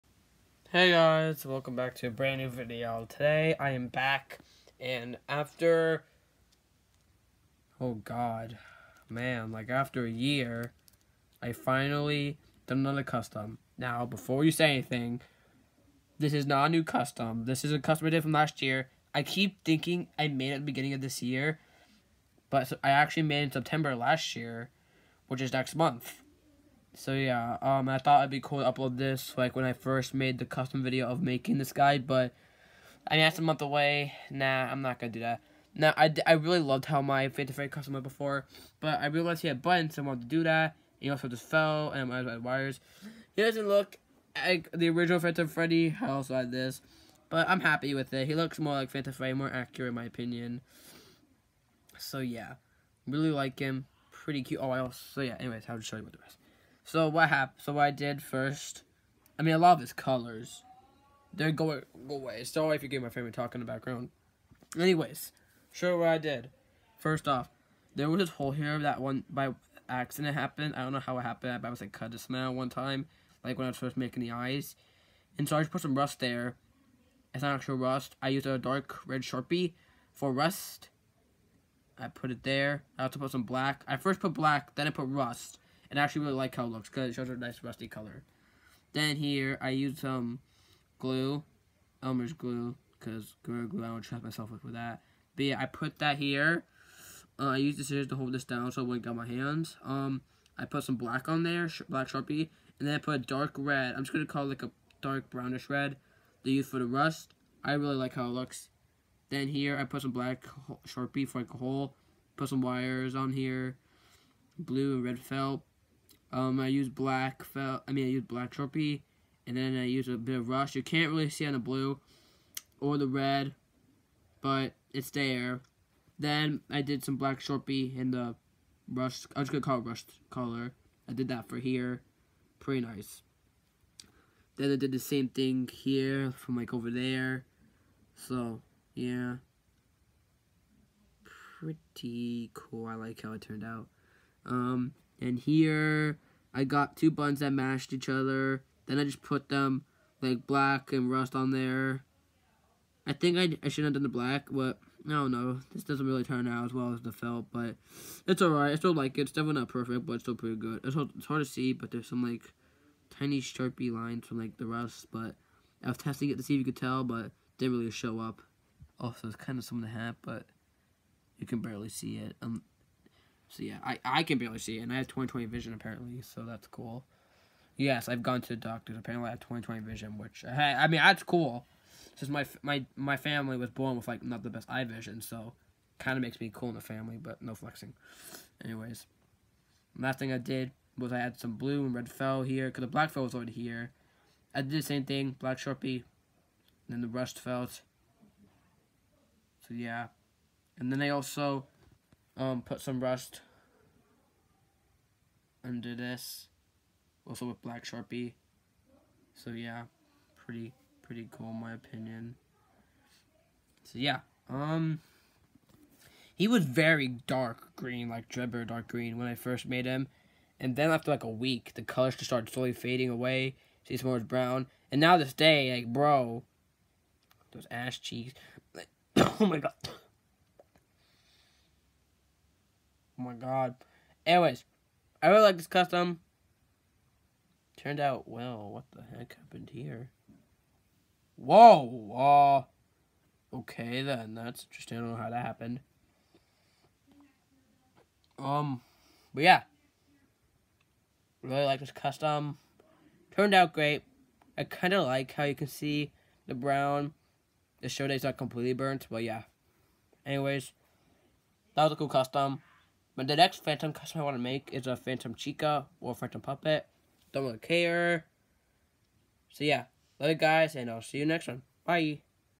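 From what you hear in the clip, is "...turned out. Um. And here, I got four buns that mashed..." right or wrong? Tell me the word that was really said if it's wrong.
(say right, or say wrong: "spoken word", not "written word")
wrong: "two", not "four".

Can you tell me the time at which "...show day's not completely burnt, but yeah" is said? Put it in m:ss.
4:17.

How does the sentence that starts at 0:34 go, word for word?
Nah, I'm not gonna do that.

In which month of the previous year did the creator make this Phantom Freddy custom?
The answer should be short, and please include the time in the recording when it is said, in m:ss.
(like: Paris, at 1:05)
September, at 0:23.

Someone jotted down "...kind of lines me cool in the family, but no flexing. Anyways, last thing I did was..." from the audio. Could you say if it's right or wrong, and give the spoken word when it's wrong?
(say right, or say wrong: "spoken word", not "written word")
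wrong: "makes", not "lines".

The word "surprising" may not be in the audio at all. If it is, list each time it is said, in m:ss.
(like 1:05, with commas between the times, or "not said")
not said.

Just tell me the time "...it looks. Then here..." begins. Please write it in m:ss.
1:48.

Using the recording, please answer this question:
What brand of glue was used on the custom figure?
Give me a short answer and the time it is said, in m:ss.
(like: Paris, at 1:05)
Elmer's, at 1:32.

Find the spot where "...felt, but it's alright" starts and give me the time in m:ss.
2:37.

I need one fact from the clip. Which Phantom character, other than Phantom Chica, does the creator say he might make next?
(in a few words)
Phantom Puppet.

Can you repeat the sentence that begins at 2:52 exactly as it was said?
Um, so yeah, I, I can barely see it, and I have 20/20 vision apparently, so that's cool.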